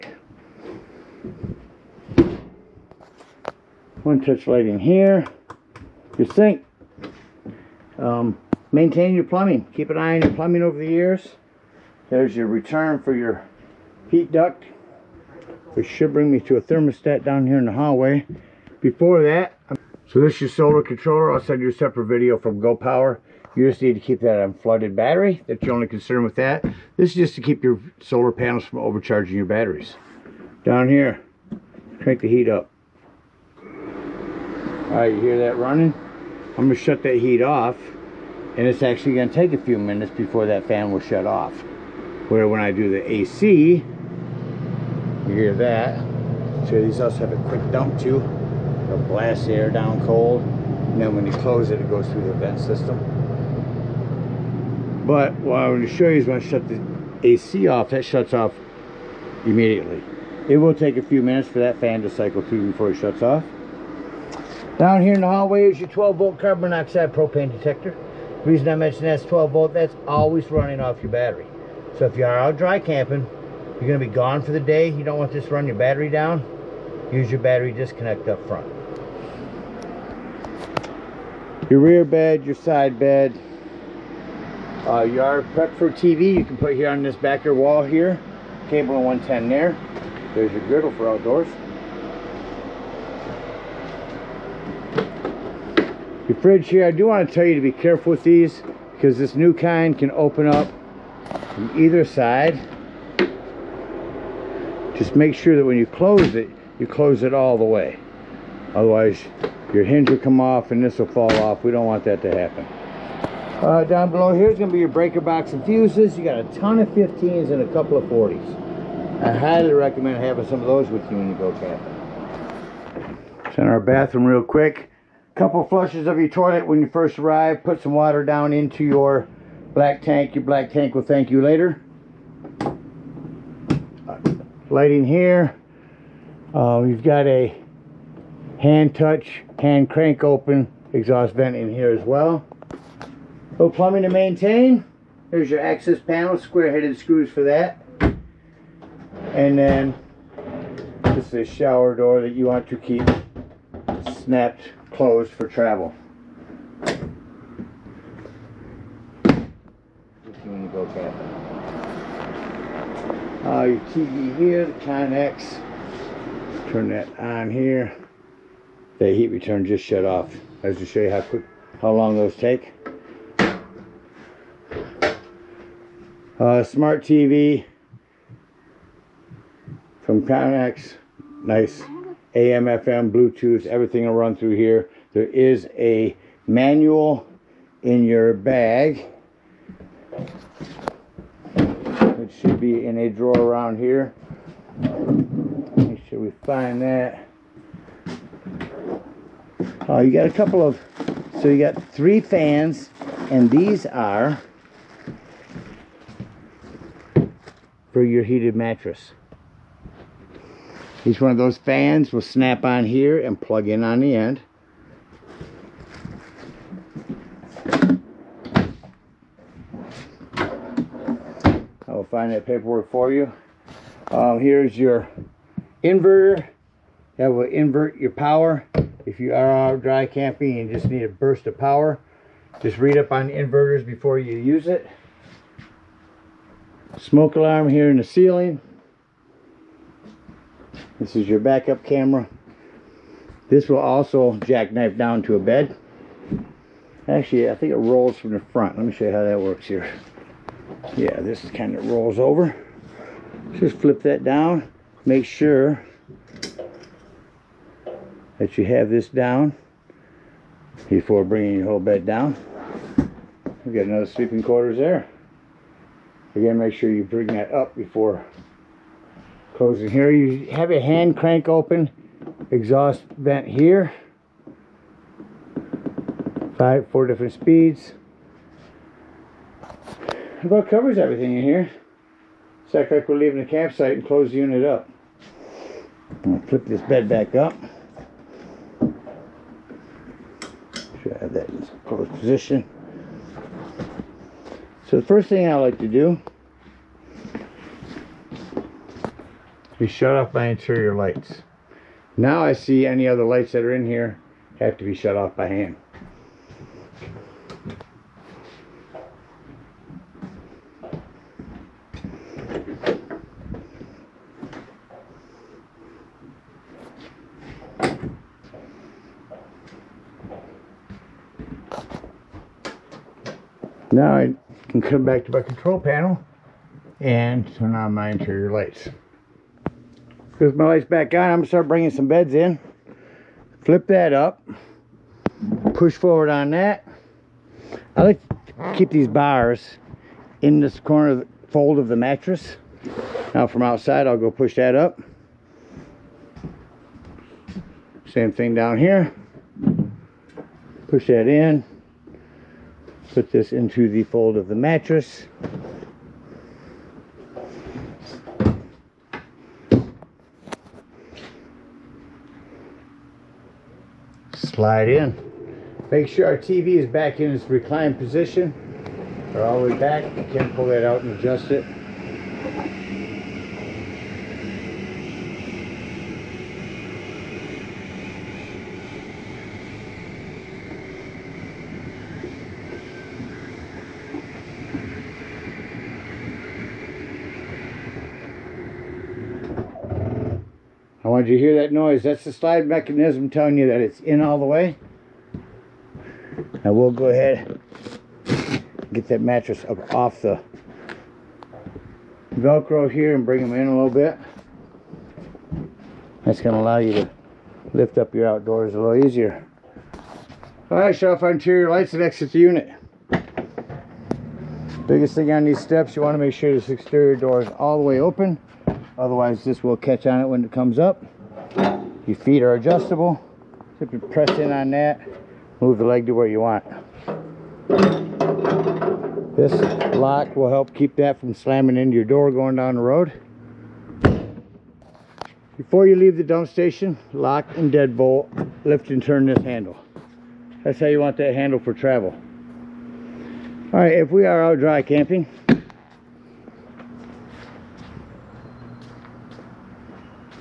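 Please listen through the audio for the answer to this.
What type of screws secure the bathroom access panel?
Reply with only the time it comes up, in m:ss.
2:26.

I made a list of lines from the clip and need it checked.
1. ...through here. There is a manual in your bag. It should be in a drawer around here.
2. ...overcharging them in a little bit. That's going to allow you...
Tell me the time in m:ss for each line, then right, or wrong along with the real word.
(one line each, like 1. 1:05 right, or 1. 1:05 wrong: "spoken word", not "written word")
1. 3:04 right
2. 6:43 wrong: "bring", not "overcharging".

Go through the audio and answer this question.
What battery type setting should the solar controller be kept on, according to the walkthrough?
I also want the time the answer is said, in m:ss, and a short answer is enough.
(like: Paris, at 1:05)
flooded battery, at 0:24.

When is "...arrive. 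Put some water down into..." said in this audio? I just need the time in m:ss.
2:07.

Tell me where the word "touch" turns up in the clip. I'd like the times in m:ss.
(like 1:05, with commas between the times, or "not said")
0:04, 2:18.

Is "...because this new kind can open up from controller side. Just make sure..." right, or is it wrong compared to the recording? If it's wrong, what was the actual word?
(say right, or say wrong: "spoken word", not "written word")
wrong: "either", not "controller".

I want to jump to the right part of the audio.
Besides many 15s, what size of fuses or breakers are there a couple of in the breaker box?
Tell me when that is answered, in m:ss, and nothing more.
1:58.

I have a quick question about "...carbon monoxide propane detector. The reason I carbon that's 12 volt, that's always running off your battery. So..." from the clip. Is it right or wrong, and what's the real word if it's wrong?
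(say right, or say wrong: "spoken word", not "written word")
wrong: "mention", not "carbon".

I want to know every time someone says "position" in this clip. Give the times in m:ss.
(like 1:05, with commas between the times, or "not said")
4:52, 6:07.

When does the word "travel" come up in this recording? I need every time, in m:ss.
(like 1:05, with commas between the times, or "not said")
2:35, 7:21.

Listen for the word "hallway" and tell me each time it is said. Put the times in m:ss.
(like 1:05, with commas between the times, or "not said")
0:17, 1:05.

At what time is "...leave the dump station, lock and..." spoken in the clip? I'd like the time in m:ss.
7:15.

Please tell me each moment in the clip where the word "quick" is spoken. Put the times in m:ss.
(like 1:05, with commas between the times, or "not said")
0:47, 2:04, 2:51.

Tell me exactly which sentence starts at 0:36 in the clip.
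I'm gonna shut that heat off and it's actually gonna take a few minutes before that fan will shut off.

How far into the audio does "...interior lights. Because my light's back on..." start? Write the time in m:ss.
5:28.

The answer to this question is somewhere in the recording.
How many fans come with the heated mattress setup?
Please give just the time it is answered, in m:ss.
3:21.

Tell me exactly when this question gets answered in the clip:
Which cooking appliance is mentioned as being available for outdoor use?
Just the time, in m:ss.
1:30.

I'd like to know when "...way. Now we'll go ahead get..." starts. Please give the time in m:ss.
6:34.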